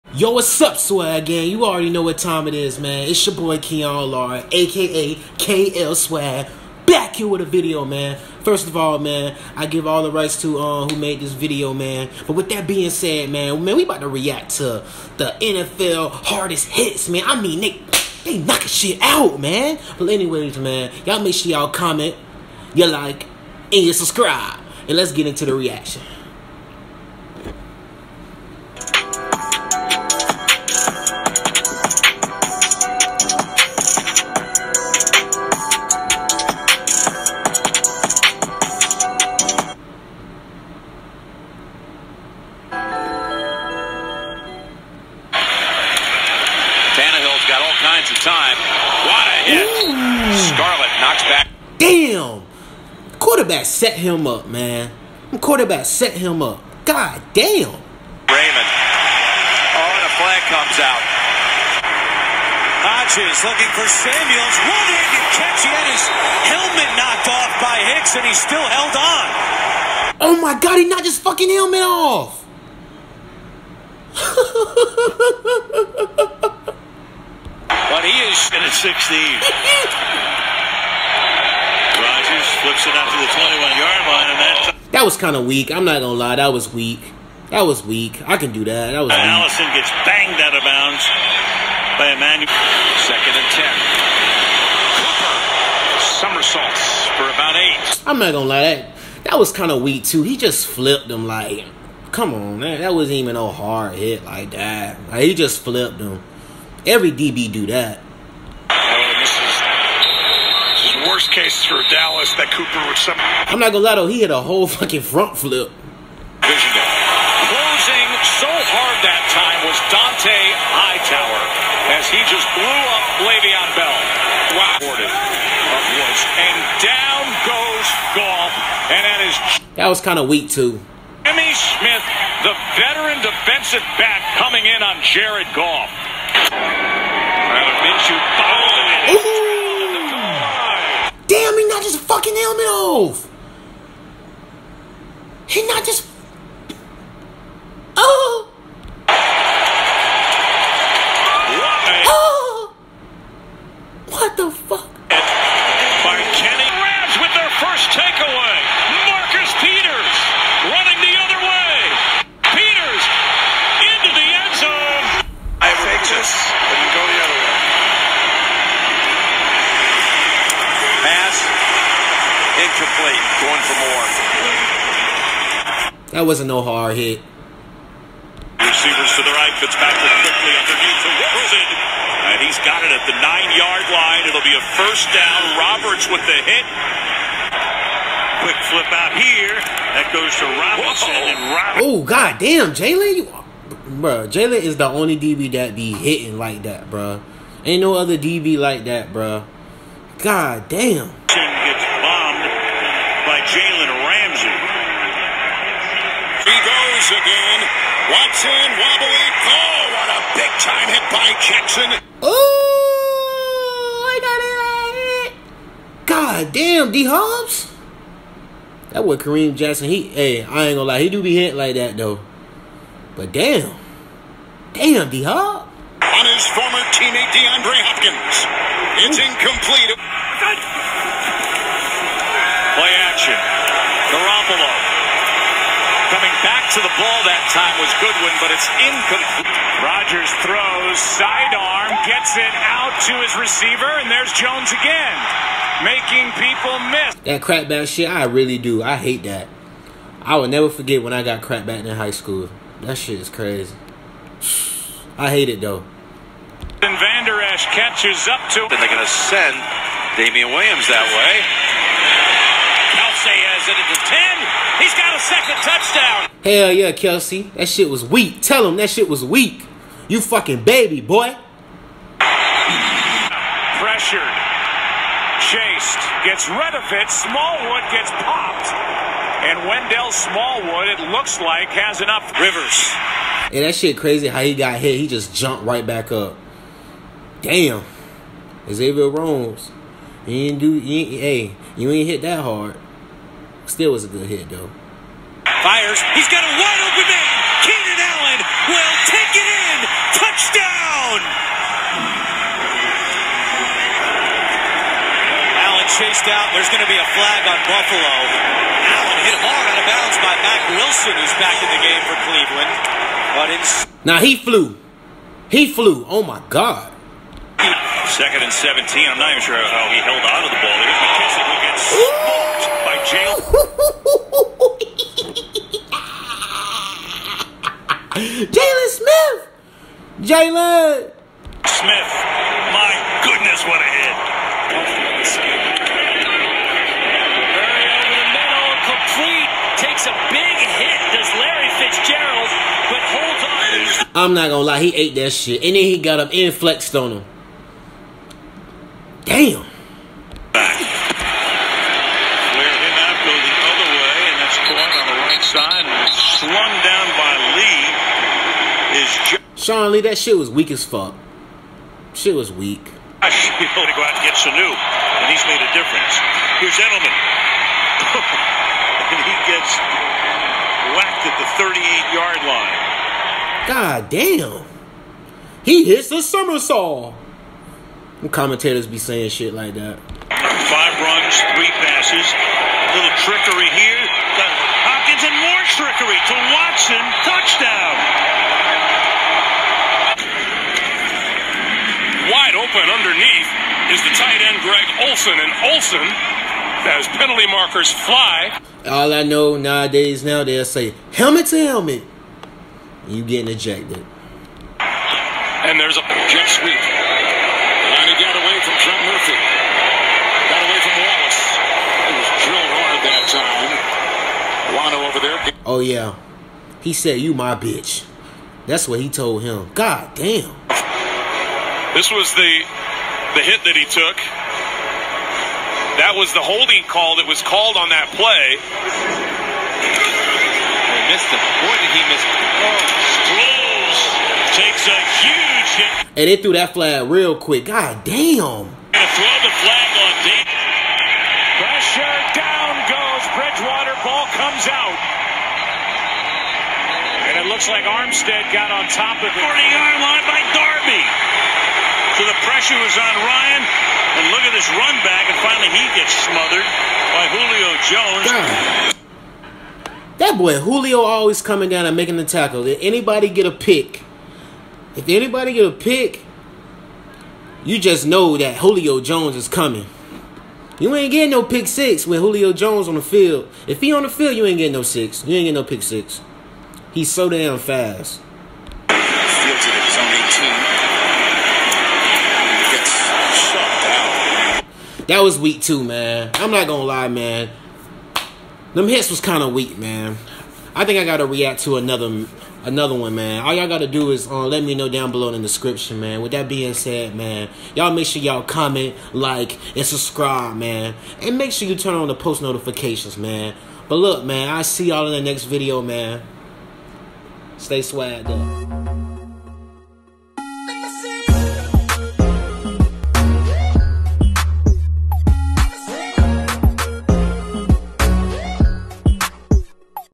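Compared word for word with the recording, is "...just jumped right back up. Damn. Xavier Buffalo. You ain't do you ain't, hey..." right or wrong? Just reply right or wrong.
wrong.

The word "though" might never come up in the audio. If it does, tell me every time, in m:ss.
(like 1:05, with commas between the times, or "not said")
1:54, 3:41, 4:15, 4:54.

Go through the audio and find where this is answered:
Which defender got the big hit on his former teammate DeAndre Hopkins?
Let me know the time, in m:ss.
3:39.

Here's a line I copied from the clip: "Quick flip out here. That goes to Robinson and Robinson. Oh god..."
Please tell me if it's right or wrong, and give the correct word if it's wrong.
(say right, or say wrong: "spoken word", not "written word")
right.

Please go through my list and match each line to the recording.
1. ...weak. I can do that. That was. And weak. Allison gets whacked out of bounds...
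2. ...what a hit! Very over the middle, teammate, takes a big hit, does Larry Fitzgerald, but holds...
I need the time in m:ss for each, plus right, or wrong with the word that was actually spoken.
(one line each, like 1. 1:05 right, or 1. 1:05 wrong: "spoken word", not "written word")
1. 1:27 wrong: "banged", not "whacked"
2. 5:33 wrong: "complete", not "teammate".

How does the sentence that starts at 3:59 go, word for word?
Rogers throws, sidearm, gets it out to his receiver, and there's Jones again, making people miss.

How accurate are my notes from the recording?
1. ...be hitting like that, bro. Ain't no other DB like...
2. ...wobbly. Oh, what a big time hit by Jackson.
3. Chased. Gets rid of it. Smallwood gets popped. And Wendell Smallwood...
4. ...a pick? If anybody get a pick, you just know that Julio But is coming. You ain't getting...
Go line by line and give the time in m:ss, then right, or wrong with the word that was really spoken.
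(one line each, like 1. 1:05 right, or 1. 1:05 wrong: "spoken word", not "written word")
1. 3:15 right
2. 3:28 right
3. 4:35 right
4. 7:43 wrong: "Jones", not "But".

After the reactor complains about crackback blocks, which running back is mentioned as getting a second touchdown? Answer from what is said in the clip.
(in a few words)
Damien Williams.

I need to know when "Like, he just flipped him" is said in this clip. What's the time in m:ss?
1:45.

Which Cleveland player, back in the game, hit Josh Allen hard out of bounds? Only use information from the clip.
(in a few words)
Mack Wilson.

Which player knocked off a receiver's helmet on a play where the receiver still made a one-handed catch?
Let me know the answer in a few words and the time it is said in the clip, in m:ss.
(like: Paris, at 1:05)
Hicks, at 1:07.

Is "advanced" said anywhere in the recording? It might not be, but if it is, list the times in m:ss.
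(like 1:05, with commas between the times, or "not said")
not said.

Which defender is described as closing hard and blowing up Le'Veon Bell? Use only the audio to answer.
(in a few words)
Dont'a Hightower.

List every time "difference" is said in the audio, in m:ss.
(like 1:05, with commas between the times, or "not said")
6:05.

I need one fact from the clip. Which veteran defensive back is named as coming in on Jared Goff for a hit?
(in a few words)
Jimmy Smith.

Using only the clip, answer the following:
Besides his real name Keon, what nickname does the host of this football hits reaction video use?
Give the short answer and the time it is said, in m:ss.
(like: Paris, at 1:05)
KL Swag, at 0:05.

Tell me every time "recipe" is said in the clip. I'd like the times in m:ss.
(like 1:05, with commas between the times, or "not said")
not said.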